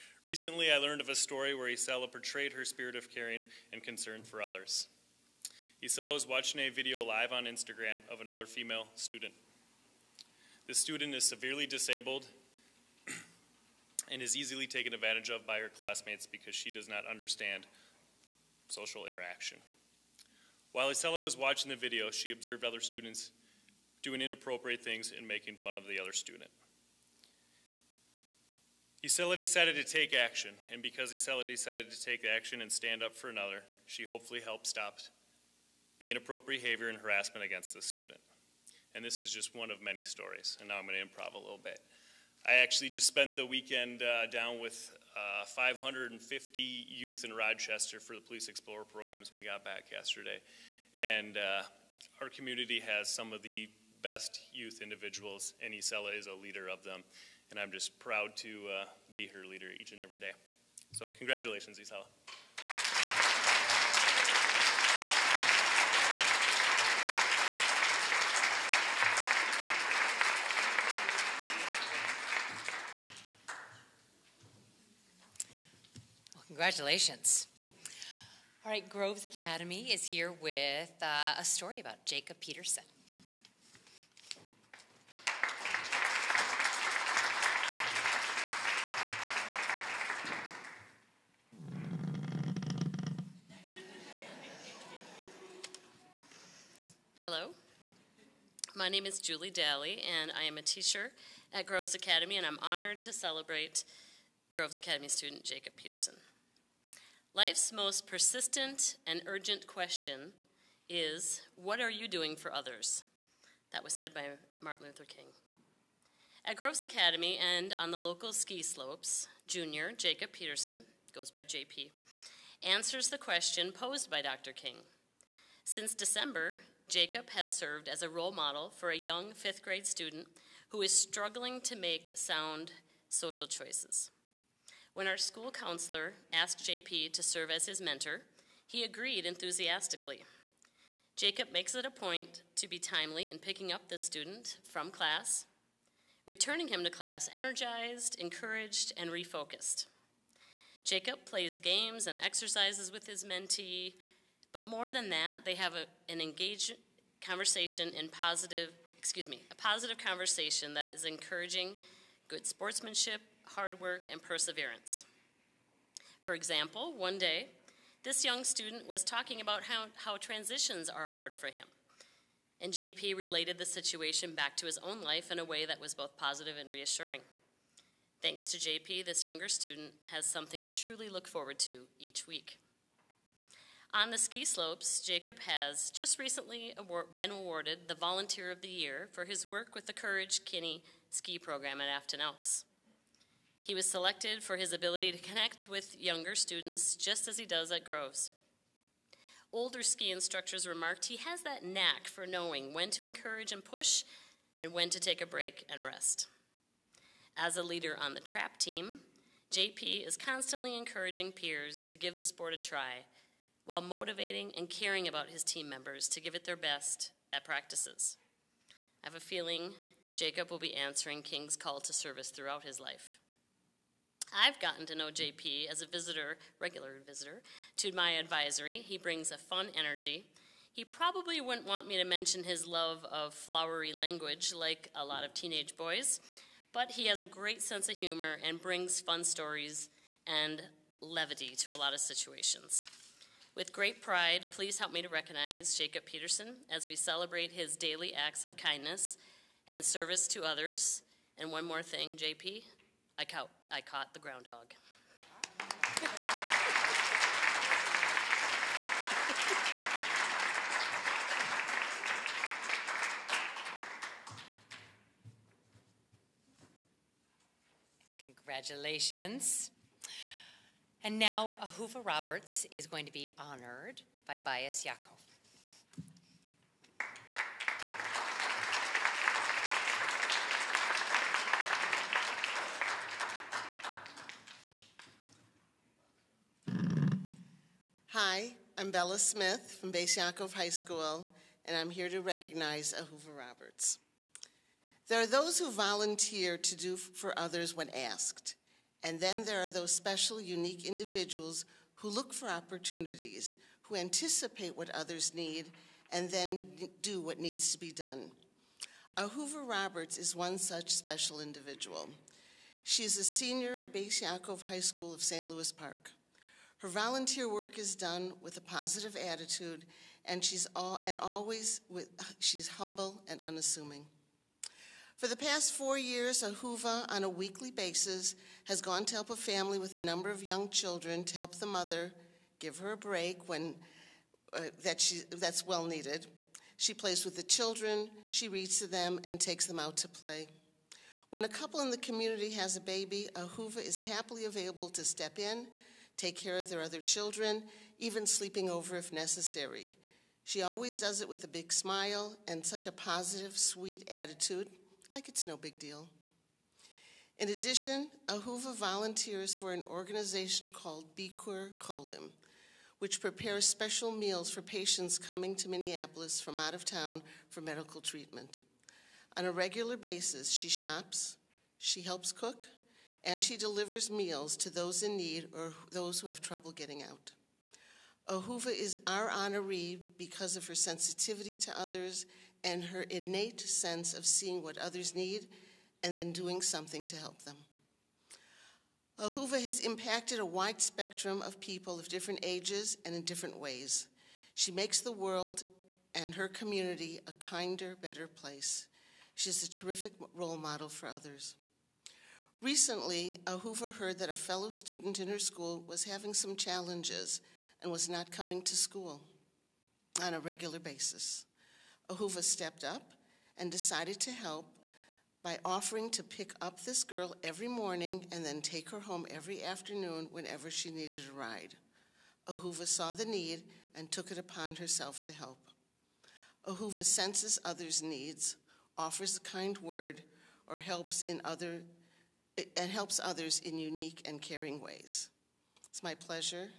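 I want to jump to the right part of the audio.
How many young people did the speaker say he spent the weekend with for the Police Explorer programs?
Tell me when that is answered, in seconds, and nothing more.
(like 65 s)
45 s.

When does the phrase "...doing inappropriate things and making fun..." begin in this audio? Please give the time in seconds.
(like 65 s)
24 s.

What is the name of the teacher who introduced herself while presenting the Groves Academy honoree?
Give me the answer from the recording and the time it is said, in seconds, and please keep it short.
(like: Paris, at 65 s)
Julie Daly, at 99 s.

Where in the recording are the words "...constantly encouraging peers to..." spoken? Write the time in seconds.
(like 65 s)
210 s.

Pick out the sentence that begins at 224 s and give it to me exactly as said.
I've gotten to know JP as a visitor, regular visitor, to my advisory.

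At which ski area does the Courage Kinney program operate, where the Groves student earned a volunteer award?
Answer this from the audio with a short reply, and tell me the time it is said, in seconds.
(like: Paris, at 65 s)
Afton Alps, at 191 s.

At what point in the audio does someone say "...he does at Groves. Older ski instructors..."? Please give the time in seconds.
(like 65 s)
197 s.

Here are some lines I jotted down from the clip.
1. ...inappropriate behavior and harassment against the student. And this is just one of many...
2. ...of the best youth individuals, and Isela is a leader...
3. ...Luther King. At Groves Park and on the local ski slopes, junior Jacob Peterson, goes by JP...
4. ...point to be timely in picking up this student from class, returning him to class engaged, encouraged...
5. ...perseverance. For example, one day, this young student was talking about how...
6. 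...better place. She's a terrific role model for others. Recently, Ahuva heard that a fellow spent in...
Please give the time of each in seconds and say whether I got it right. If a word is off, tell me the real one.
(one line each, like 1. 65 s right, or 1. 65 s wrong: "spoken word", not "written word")
1. 36 s right
2. 53 s right
3. 114 s wrong: "Academy", not "Park"
4. 141 s wrong: "energized", not "engaged"
5. 164 s right
6. 398 s wrong: "student", not "spent".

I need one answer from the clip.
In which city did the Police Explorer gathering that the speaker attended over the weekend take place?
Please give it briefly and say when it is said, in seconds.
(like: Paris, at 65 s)
Rochester, at 47 s.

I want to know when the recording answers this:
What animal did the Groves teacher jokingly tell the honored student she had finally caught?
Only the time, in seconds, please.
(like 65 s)
254 s.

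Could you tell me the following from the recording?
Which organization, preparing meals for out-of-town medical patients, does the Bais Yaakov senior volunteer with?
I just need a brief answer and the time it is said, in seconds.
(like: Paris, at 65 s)
Bikur Cholim, at 361 s.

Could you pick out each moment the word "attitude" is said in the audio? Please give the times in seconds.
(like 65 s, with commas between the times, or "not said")
319 s, 354 s.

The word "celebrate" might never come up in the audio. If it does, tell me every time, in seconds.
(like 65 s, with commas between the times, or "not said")
103 s, 246 s.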